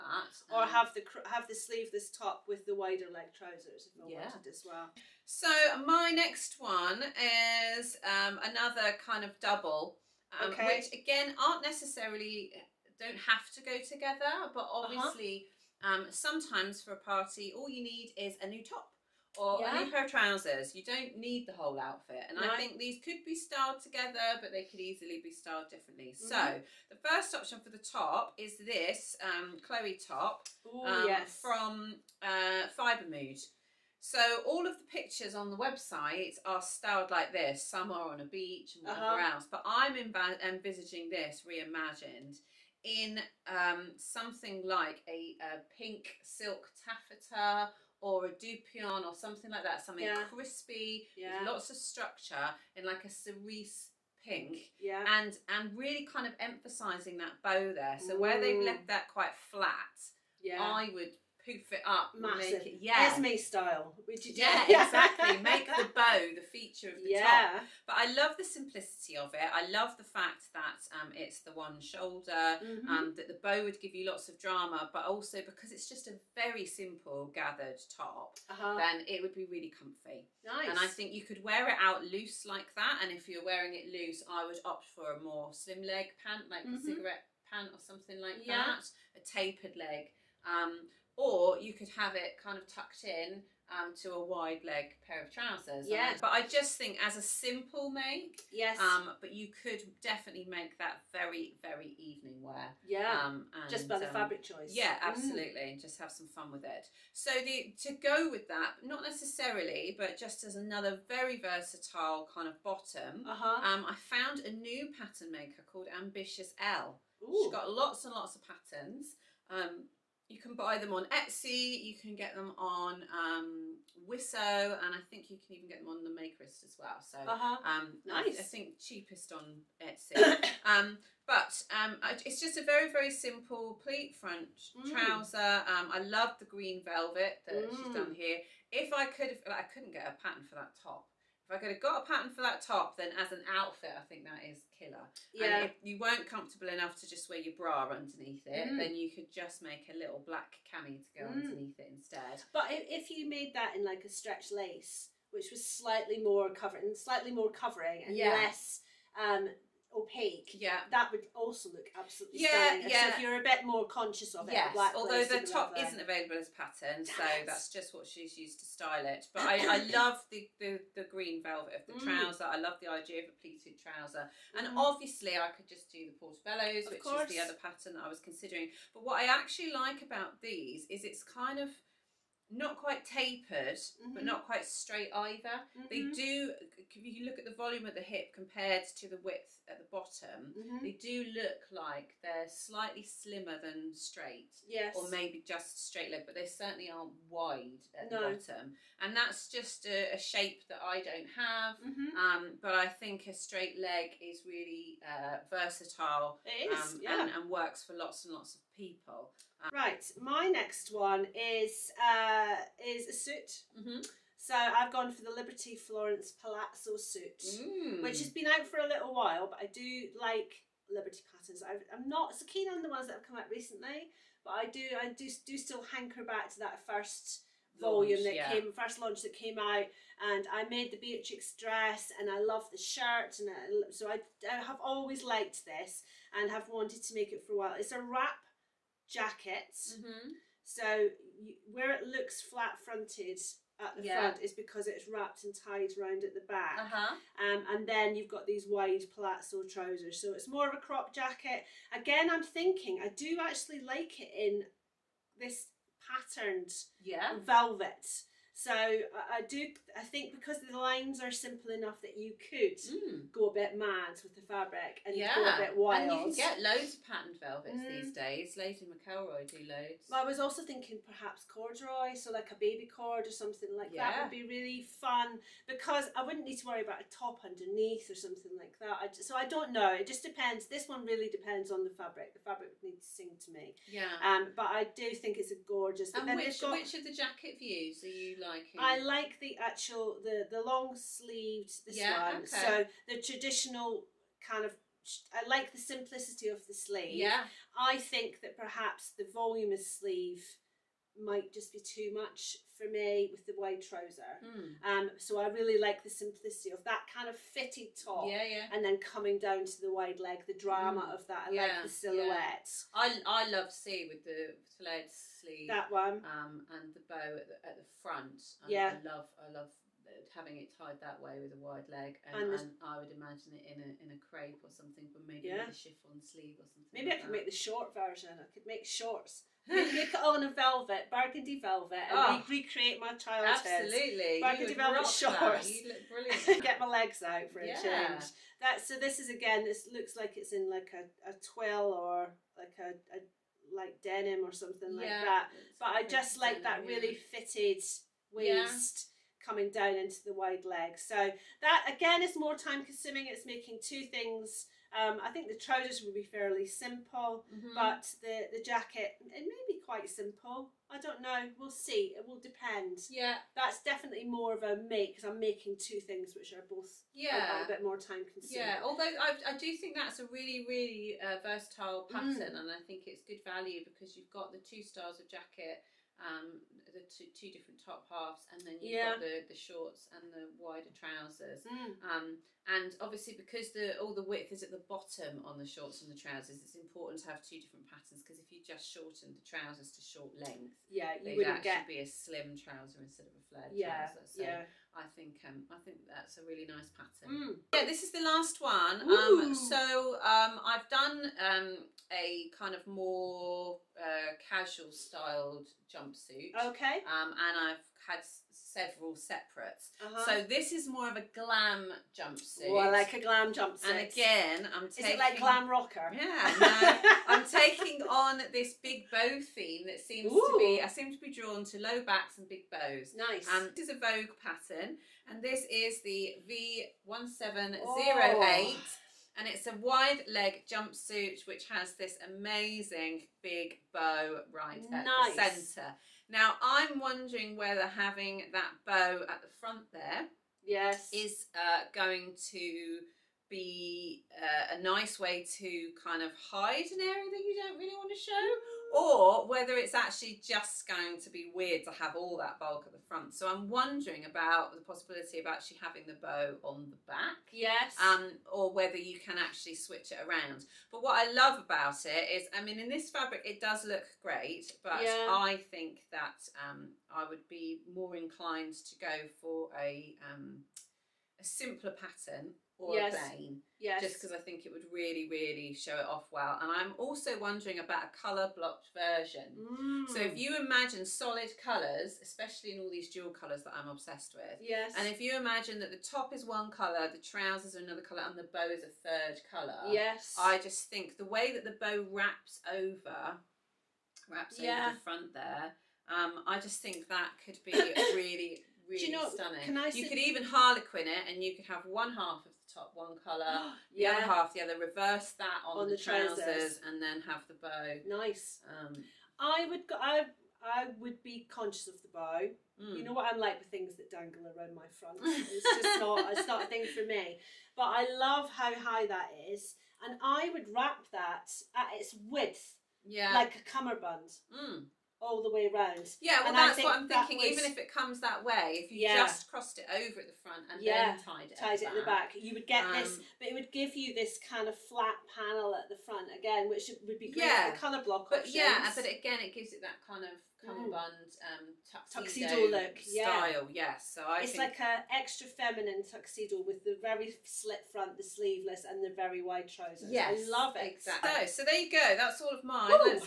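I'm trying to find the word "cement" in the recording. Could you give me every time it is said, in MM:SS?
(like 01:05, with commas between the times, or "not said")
not said.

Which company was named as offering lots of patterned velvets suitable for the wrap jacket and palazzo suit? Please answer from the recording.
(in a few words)
Lady McElroy.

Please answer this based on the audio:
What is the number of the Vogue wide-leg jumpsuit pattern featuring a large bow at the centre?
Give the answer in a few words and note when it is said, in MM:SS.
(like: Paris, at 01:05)
V1708, at 07:06.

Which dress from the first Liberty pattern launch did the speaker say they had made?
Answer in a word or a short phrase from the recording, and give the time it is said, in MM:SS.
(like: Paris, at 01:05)
Beatrix, at 03:51.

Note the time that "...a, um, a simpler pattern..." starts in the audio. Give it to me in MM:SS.
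07:49.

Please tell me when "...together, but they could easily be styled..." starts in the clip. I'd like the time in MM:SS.
00:23.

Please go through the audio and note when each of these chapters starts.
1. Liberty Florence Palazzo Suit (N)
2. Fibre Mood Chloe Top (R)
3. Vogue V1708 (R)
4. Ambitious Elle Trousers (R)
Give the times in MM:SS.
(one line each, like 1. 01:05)
1. 03:21
2. 00:06
3. 06:36
4. 01:56.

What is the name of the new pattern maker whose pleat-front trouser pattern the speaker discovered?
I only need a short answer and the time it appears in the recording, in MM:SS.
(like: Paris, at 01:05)
Ambitious Elle, at 01:56.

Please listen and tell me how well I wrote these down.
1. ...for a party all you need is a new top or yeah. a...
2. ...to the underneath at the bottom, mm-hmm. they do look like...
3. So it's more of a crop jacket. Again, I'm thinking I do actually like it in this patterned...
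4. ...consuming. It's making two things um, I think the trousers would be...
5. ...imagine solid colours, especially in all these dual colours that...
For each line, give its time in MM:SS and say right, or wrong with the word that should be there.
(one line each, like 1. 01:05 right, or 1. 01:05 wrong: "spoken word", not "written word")
1. 00:16 right
2. 03:09 wrong: "width", not "underneath"
3. 04:10 right
4. 05:52 right
5. 08:00 right.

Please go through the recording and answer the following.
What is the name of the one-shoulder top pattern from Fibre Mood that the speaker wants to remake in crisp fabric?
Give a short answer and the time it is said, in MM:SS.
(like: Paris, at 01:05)
Chloe, at 00:29.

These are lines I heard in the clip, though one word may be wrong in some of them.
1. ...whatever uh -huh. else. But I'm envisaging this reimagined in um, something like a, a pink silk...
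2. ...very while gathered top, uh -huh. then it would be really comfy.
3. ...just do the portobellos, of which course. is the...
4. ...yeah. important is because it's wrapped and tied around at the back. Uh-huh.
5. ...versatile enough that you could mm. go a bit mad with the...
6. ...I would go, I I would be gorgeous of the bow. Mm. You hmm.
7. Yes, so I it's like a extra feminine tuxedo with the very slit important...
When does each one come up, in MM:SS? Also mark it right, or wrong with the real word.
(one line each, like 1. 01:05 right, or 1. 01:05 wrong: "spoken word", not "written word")
1. 00:38 right
2. 01:16 wrong: "simple", not "while"
3. 02:55 right
4. 04:04 wrong: "front", not "important"
5. 04:21 wrong: "simple", not "versatile"
6. 08:29 wrong: "conscious", not "gorgeous"
7. 09:03 wrong: "front", not "important".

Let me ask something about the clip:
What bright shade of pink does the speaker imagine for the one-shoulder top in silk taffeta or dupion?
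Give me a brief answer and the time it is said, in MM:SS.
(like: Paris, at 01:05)
cerise, at 00:53.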